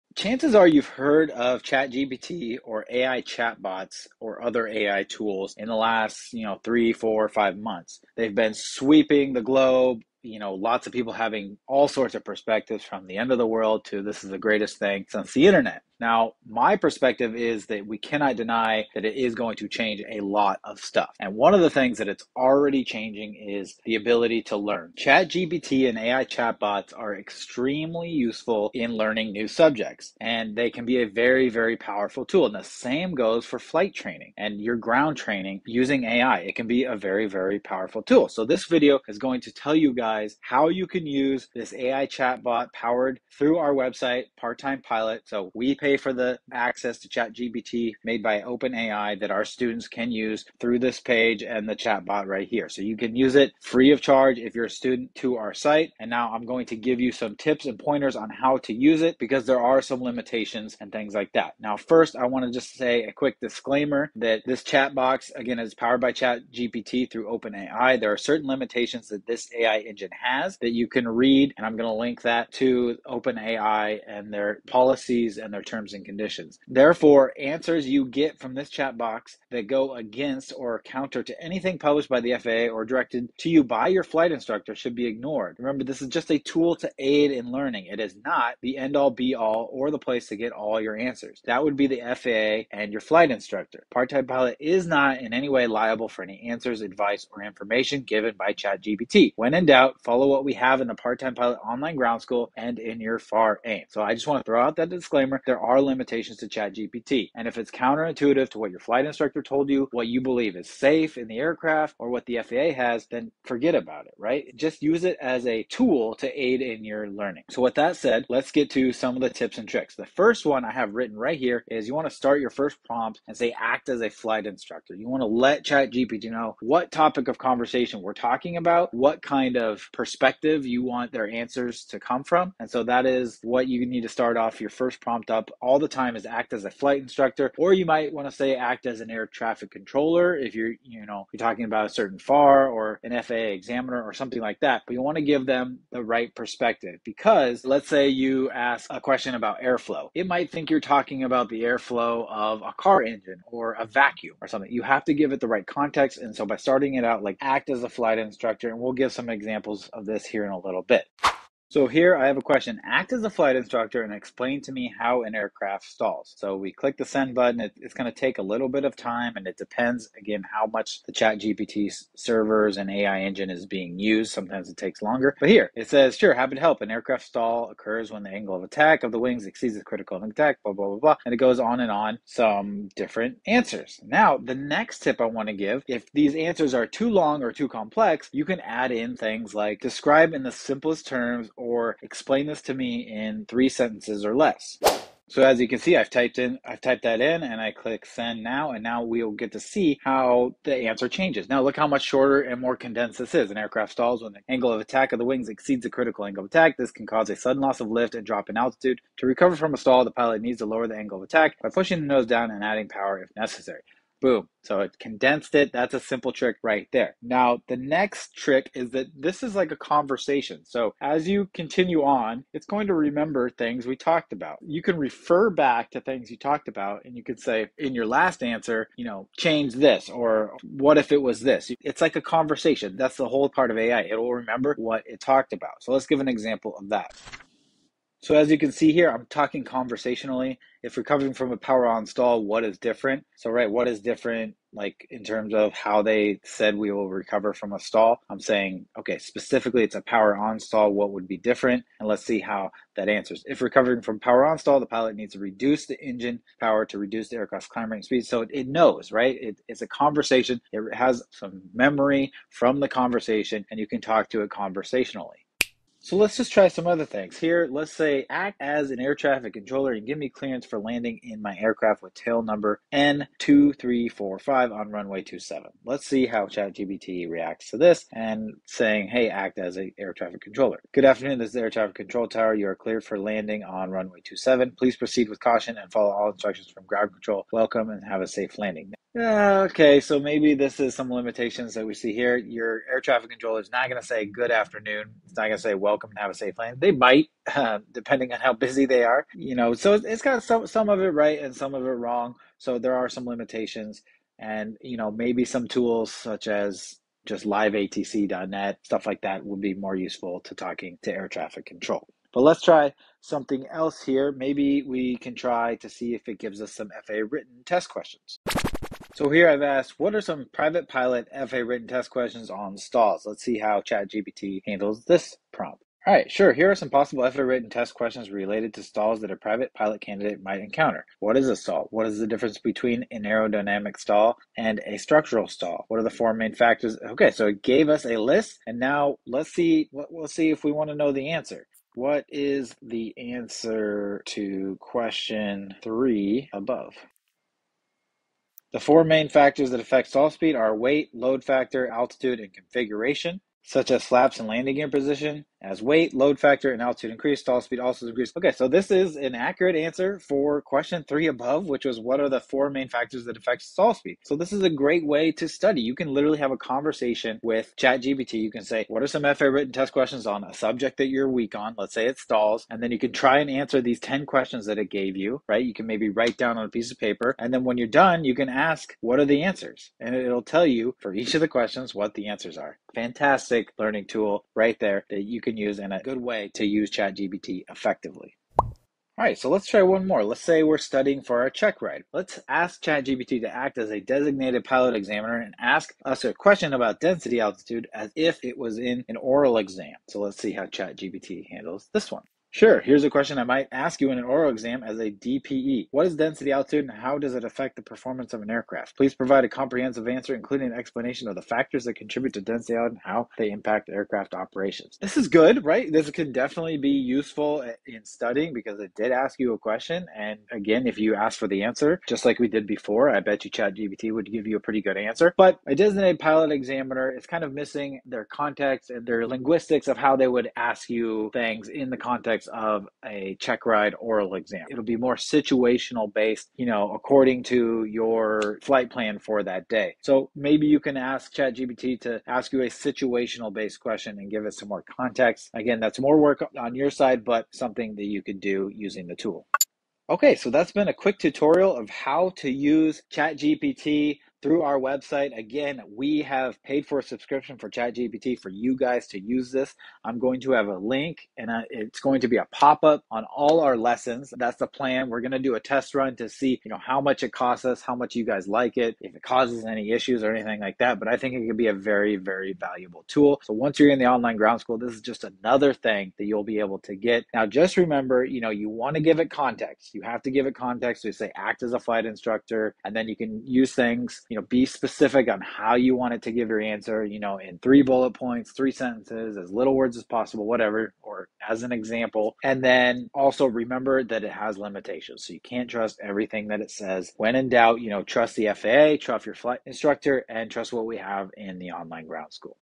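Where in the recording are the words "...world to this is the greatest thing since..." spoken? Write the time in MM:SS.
00:13.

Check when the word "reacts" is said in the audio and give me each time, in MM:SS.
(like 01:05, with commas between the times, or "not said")
04:37.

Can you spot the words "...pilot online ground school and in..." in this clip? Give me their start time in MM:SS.
01:41.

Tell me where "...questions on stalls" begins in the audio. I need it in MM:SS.
05:22.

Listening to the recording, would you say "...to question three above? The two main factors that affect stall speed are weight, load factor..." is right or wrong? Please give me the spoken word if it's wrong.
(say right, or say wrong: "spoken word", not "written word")
wrong: "four", not "two".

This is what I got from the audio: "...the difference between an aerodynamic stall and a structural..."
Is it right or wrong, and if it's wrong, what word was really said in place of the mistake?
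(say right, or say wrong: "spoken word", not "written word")
right.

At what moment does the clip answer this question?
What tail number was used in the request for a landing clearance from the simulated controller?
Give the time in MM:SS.
04:32.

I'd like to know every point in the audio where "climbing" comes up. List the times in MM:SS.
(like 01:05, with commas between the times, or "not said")
04:17.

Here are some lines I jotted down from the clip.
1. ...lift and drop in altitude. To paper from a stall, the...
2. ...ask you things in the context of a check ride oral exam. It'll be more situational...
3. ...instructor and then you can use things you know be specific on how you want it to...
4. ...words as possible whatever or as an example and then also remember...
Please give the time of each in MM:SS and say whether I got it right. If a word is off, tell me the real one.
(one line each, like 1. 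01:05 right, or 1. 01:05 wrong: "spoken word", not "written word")
1. 03:27 wrong: "recover", not "paper"
2. 07:10 right
3. 08:02 right
4. 08:09 right.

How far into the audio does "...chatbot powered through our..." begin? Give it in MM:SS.
00:42.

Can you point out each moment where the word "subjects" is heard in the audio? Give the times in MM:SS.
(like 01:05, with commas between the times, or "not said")
00:29, 06:10.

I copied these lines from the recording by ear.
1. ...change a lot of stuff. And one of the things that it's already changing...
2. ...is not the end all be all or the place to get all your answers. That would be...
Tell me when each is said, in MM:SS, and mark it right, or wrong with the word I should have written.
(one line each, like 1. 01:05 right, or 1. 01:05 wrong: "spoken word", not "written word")
1. 00:19 right
2. 01:27 right.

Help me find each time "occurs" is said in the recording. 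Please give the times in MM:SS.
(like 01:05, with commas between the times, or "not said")
02:57.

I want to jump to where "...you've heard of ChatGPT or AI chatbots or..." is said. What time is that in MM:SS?
00:00.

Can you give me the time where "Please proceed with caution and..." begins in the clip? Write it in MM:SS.
04:44.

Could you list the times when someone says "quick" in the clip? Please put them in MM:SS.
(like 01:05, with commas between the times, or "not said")
01:03, 07:30.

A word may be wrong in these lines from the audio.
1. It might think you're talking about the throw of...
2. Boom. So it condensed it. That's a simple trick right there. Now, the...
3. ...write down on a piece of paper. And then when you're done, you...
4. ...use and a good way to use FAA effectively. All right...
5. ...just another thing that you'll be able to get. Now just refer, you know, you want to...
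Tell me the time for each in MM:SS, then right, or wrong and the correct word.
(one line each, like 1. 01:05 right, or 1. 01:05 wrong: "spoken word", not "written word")
1. 02:30 wrong: "airflow", not "throw"
2. 03:34 right
3. 06:16 right
4. 06:25 wrong: "ChatGPT", not "FAA"
5. 07:55 wrong: "remember", not "refer".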